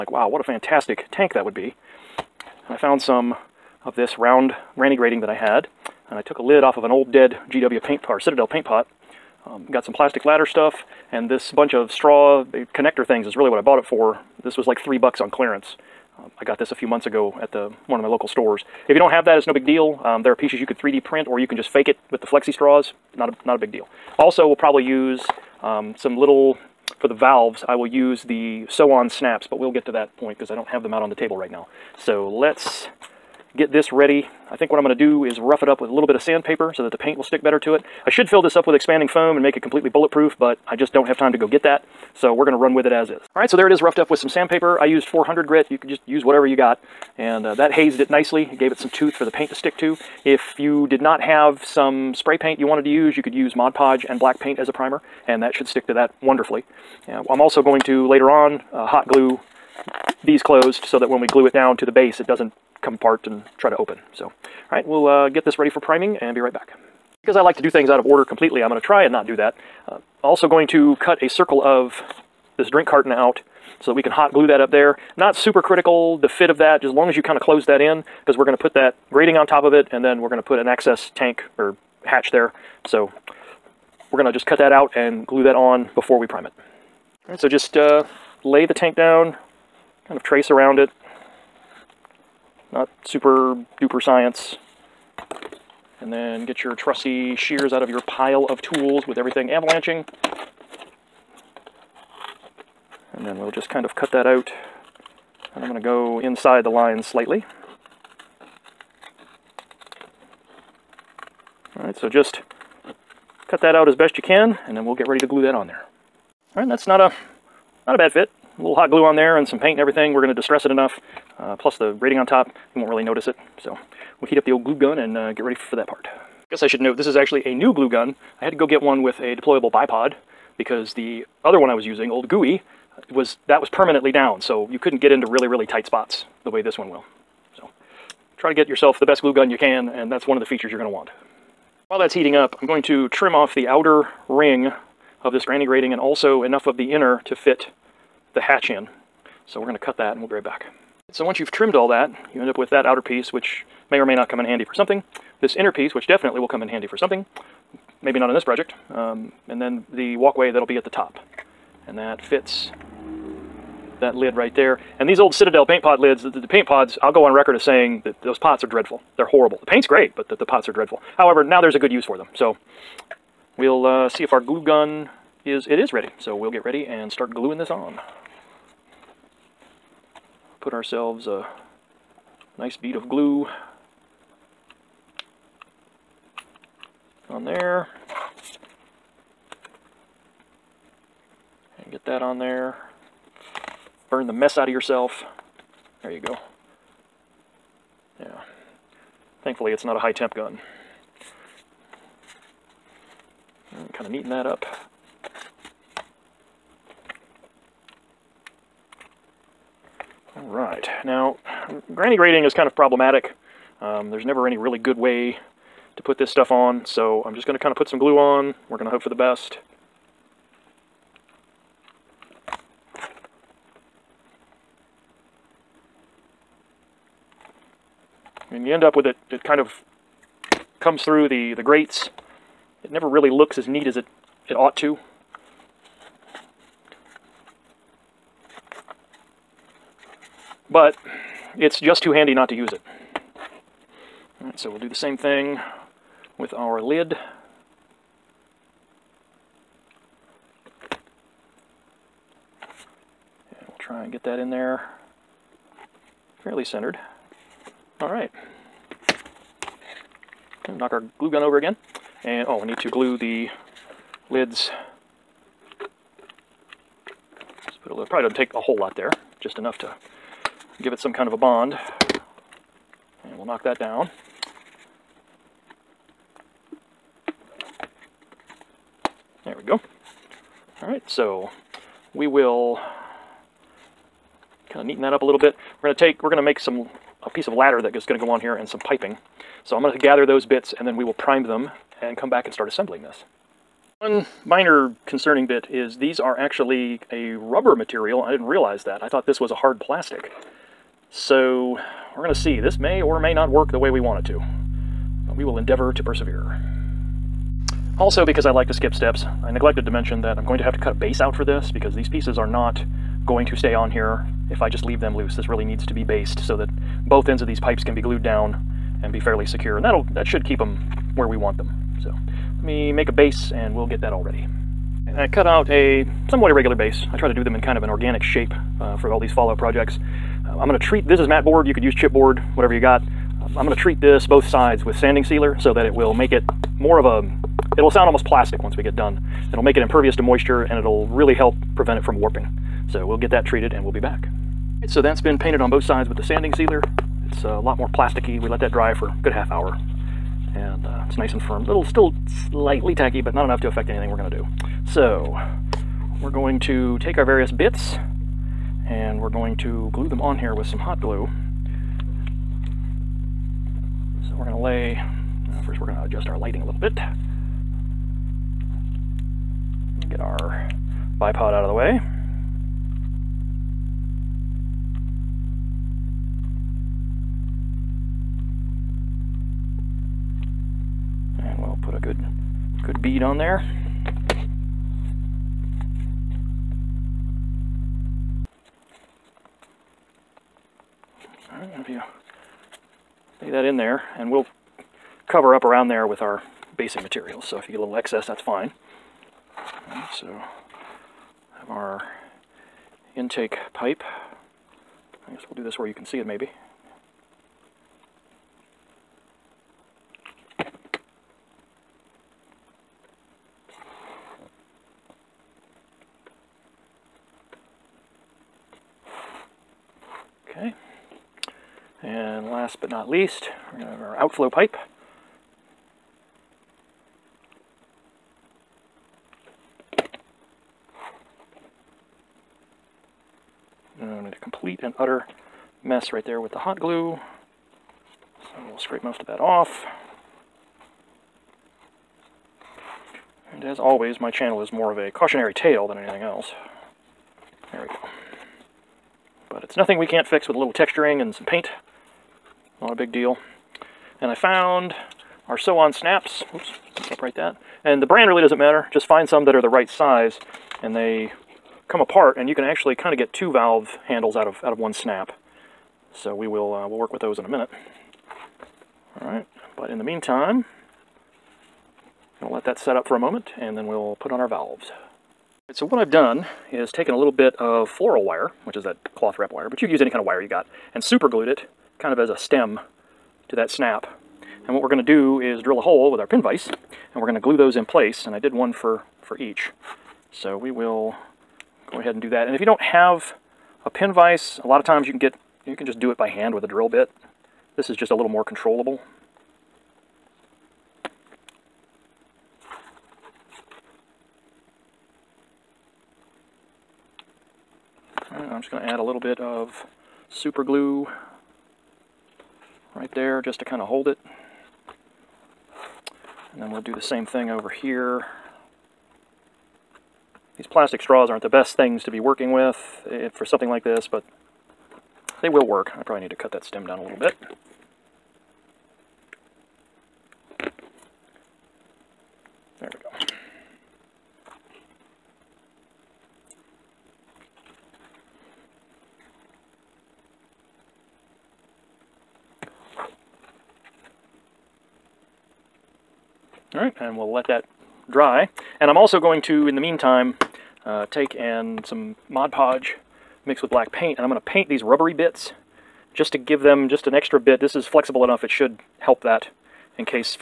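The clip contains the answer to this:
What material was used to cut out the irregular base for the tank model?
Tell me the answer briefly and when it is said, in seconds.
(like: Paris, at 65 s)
mat board, at 331 s.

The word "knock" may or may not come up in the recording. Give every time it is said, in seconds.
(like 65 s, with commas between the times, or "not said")
260 s, 273 s.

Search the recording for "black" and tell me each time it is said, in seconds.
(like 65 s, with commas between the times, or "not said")
54 s, 553 s.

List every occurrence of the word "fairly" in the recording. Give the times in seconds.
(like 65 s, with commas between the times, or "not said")
256 s, 319 s.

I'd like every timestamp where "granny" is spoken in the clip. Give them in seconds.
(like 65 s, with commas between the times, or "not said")
4 s, 145 s, 211 s.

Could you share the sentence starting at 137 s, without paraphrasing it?
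So try to get yourself the best glue gun you can, and that's one of the features you're going to want.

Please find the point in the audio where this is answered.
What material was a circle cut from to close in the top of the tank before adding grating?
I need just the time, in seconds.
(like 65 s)
72 s.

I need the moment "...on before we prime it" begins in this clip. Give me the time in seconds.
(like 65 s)
85 s.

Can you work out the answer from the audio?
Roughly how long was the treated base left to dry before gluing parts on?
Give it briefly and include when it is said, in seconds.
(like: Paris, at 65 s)
half hour, at 349 s.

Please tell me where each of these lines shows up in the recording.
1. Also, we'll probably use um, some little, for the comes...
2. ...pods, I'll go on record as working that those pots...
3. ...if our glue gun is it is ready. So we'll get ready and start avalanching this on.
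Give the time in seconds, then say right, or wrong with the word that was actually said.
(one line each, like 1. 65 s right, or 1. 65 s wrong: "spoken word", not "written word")
1. 24 s wrong: "valves", not "comes"
2. 166 s wrong: "saying", not "working"
3. 174 s wrong: "gluing", not "avalanching".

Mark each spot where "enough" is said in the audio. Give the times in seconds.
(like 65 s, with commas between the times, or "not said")
120 s, 146 s, 269 s, 353 s, 558 s.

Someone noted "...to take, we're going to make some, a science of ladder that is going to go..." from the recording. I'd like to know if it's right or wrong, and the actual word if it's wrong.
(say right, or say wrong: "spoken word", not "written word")
wrong: "piece", not "science".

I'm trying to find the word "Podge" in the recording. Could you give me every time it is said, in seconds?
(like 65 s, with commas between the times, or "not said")
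53 s, 552 s.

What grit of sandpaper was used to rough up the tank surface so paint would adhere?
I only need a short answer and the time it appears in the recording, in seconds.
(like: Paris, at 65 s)
400, at 45 s.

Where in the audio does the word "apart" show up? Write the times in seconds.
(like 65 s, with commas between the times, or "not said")
62 s, 461 s.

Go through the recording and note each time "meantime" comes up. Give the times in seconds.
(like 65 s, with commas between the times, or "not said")
470 s, 549 s.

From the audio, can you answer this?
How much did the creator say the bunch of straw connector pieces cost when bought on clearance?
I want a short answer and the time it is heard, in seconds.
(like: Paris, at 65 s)
3 bucks, at 14 s.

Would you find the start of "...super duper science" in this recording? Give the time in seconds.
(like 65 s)
93 s.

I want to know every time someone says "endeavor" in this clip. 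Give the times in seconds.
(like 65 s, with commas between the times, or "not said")
305 s.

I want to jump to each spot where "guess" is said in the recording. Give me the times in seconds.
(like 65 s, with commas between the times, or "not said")
126 s, 405 s.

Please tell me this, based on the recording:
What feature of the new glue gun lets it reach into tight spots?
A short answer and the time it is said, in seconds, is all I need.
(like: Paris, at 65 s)
deployable bipod, at 129 s.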